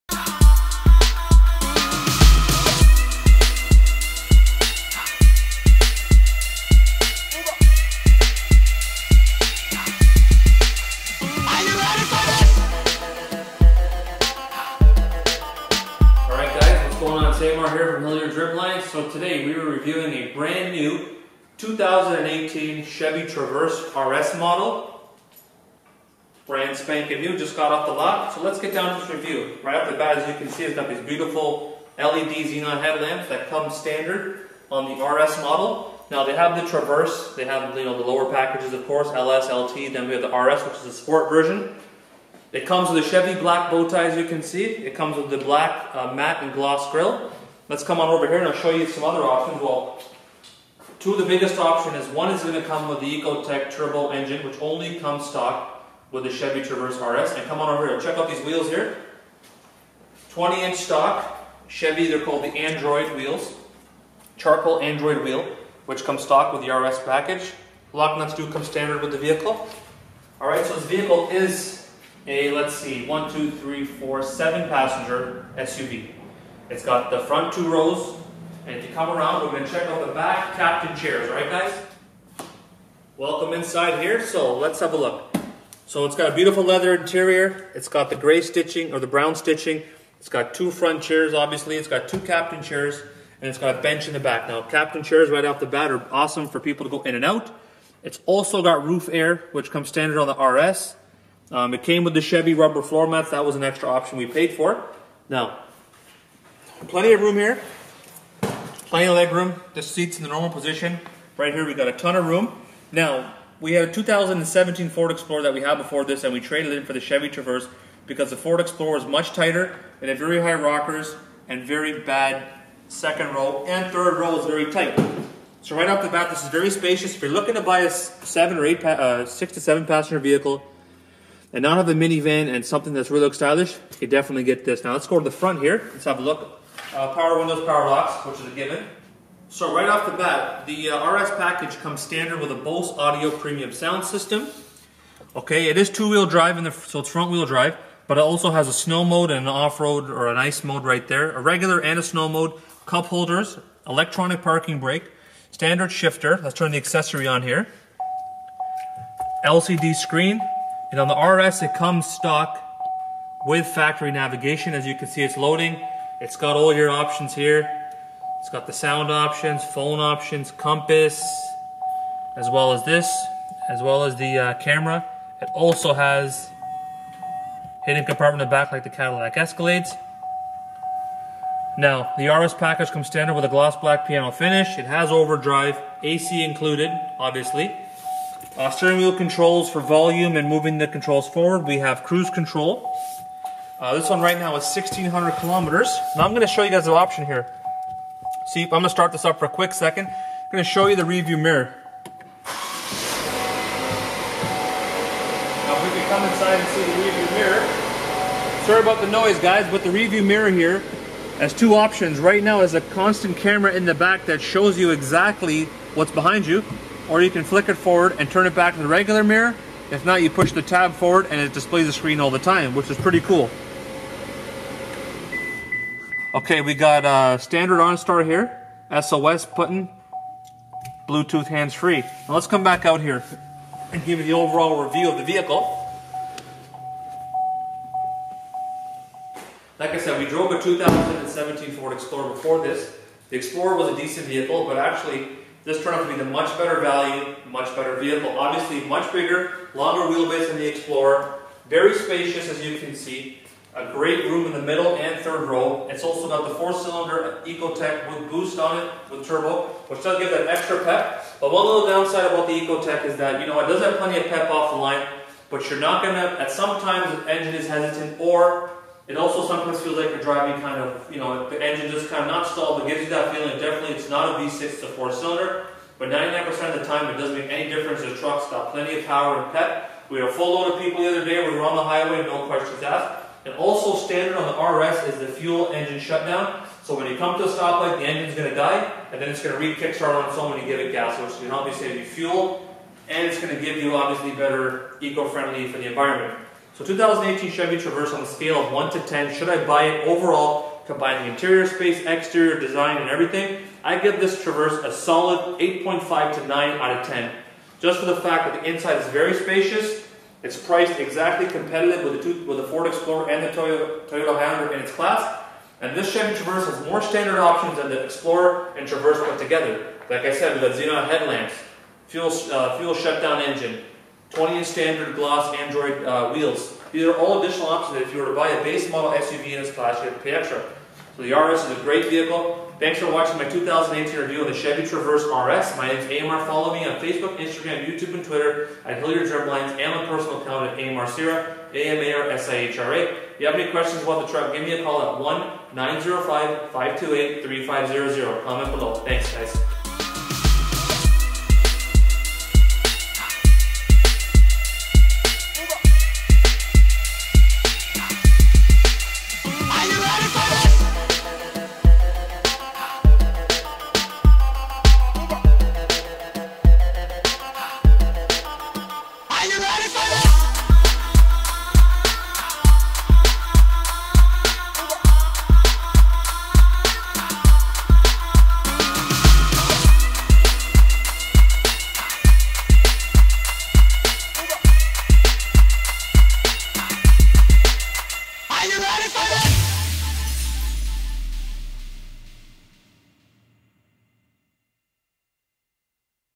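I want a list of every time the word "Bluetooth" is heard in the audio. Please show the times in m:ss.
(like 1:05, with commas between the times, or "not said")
3:51.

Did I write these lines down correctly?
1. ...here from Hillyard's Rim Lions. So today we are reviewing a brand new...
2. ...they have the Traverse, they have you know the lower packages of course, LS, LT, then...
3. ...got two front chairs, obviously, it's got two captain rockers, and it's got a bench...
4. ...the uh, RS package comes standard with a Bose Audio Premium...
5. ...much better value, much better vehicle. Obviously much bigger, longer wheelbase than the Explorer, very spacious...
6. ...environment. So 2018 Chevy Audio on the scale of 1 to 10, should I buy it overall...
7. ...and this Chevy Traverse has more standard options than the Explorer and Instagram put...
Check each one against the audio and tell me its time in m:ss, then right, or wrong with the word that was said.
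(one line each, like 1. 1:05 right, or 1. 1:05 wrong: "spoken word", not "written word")
1. 0:17 right
2. 0:36 right
3. 1:30 wrong: "chairs", not "rockers"
4. 2:20 right
5. 4:06 right
6. 4:55 wrong: "Traverse", not "Audio"
7. 5:15 wrong: "Traverse", not "Instagram".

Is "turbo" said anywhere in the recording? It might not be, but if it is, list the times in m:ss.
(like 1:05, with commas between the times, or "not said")
0:53, 4:19.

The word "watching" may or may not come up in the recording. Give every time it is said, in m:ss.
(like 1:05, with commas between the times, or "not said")
5:33.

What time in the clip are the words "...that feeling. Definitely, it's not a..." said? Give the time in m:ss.
4:33.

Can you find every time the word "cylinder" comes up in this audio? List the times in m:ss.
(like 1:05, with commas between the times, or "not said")
4:16, 4:35.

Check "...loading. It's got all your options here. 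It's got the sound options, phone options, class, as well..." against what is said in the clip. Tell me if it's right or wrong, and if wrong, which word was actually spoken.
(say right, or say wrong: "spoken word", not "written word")
wrong: "compass", not "class".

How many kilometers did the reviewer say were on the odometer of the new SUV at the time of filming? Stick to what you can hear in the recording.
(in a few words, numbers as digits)
1600 kilometers.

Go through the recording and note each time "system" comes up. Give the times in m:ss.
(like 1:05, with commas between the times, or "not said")
2:24.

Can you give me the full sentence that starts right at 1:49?
The seat's in the normal position.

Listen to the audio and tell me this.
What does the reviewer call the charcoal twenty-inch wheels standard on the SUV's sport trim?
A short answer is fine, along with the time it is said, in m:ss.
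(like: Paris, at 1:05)
Android wheels, at 1:02.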